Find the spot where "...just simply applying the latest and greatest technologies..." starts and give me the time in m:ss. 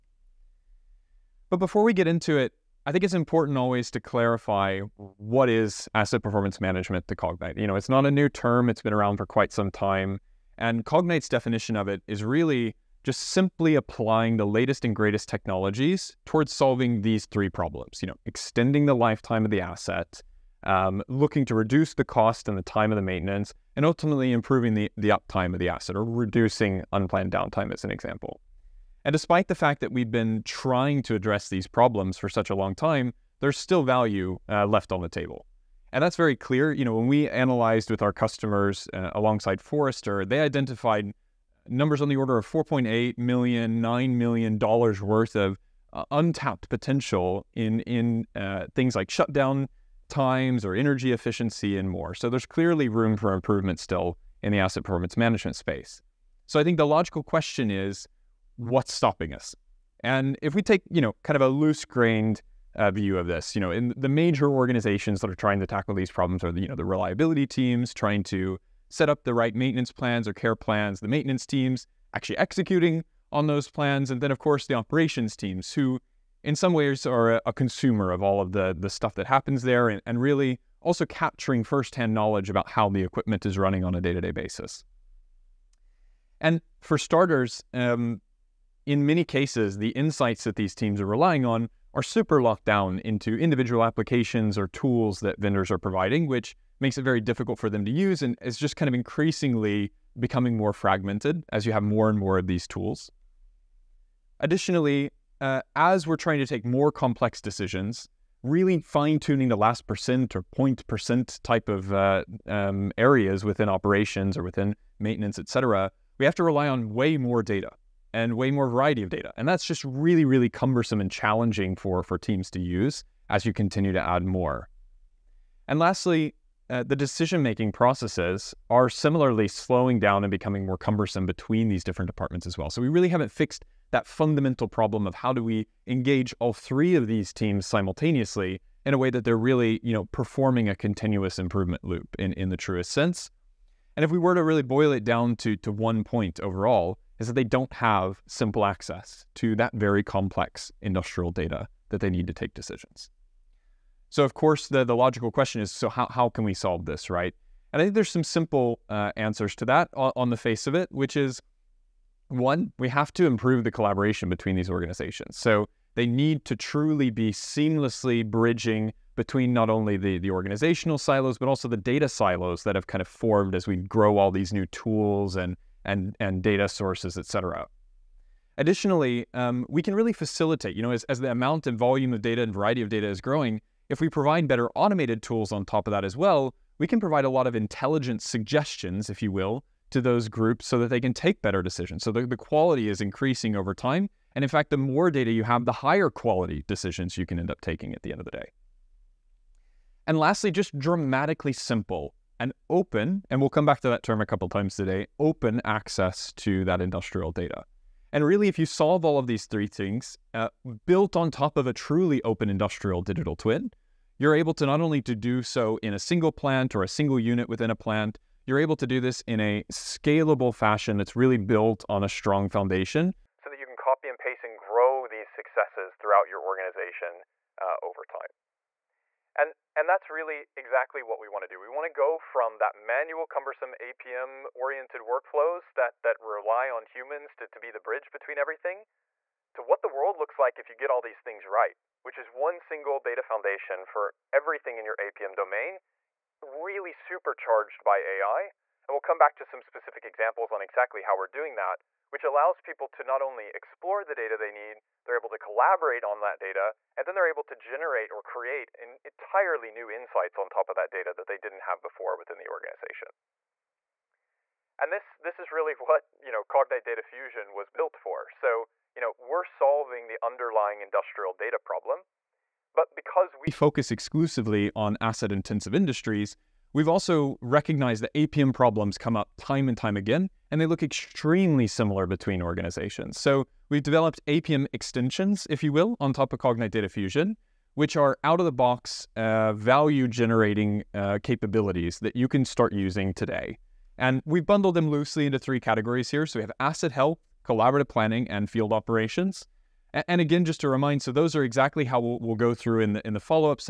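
0:13.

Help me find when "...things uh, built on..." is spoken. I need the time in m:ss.
3:29.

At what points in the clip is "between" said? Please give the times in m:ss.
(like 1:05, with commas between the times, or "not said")
2:11, 2:44, 2:49, 3:58, 4:42.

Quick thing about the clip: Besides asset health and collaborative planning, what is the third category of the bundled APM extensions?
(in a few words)
field operations.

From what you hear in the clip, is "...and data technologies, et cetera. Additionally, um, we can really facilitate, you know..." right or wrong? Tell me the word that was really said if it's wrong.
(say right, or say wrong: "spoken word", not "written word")
wrong: "sources", not "technologies".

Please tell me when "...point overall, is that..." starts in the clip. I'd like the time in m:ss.
2:26.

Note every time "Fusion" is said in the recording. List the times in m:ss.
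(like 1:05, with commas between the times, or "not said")
4:27, 4:46.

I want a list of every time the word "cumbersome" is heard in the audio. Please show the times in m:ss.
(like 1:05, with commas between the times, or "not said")
2:00, 2:10, 3:53.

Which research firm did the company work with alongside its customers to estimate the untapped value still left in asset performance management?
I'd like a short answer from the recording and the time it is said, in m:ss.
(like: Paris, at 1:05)
Forrester, at 0:39.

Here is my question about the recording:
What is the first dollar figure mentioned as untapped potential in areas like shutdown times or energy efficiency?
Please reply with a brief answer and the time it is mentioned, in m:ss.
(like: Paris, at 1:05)
4.8 million, at 0:42.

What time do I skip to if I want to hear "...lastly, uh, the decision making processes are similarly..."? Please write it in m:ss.
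2:05.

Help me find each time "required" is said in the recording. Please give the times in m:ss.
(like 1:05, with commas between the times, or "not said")
not said.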